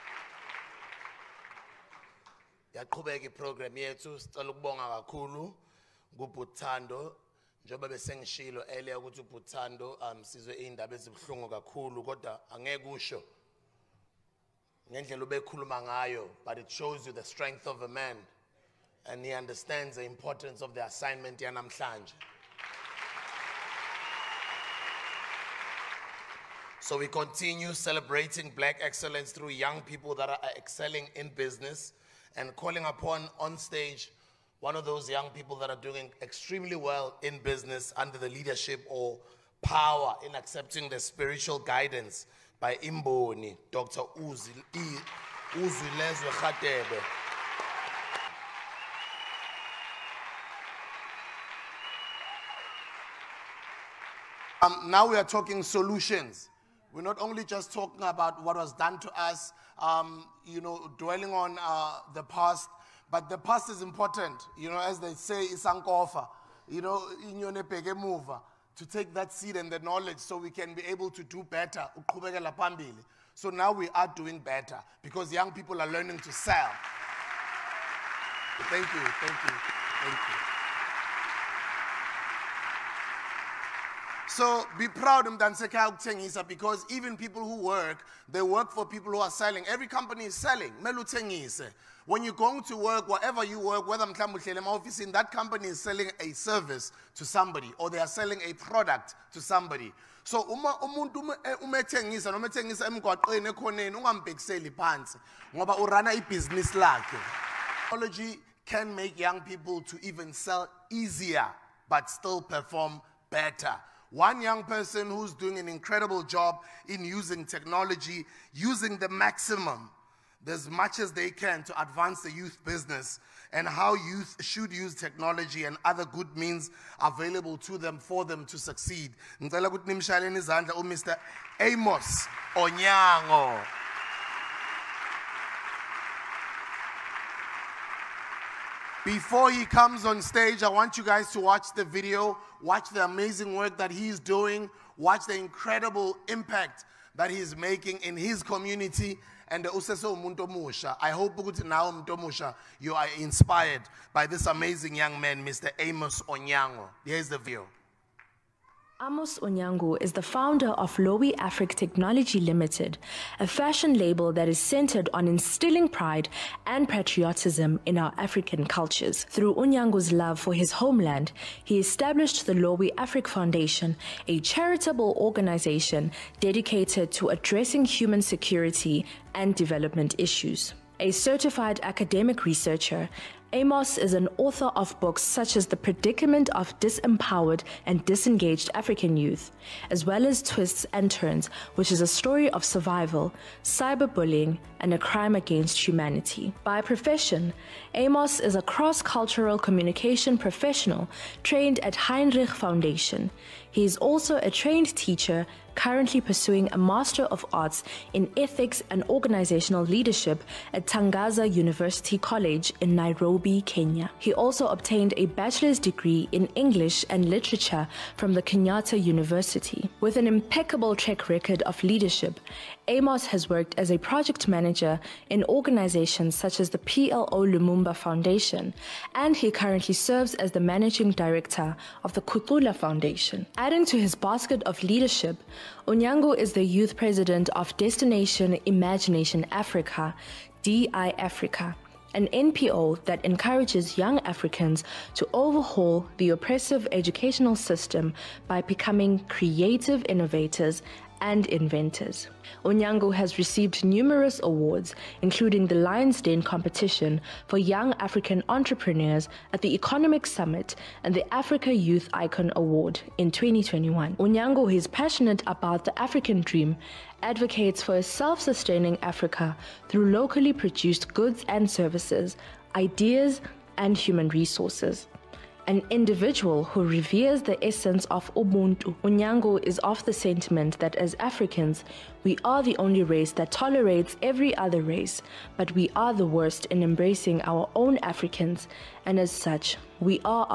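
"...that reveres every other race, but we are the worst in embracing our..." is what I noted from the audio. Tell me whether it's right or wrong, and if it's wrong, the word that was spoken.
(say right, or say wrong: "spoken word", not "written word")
wrong: "tolerates", not "reveres".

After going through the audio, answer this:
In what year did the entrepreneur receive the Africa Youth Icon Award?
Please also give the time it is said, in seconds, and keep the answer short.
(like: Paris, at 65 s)
2021, at 263 s.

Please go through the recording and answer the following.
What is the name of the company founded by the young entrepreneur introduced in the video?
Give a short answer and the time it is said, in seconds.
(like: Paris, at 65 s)
Lowy Afric Technology Limited, at 160 s.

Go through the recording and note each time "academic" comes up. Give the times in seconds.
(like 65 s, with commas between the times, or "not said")
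181 s.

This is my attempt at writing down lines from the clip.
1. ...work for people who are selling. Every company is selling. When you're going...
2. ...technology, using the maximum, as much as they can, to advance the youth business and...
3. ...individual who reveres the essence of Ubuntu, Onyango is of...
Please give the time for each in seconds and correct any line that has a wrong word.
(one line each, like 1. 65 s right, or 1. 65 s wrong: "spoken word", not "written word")
1. 88 s right
2. 117 s right
3. 275 s right.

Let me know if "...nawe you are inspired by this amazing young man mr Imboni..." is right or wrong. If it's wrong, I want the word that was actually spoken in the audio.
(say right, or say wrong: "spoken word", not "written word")
wrong: "Amos", not "Imboni".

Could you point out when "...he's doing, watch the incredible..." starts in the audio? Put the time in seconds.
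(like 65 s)
143 s.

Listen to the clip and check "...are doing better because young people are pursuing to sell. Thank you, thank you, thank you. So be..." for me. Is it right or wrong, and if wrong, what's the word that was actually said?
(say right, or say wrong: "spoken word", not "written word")
wrong: "learning", not "pursuing".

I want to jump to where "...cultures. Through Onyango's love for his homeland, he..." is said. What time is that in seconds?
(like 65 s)
168 s.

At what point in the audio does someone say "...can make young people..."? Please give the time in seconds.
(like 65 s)
108 s.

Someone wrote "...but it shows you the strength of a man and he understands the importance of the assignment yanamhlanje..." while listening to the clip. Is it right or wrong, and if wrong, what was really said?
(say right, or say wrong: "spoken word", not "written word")
right.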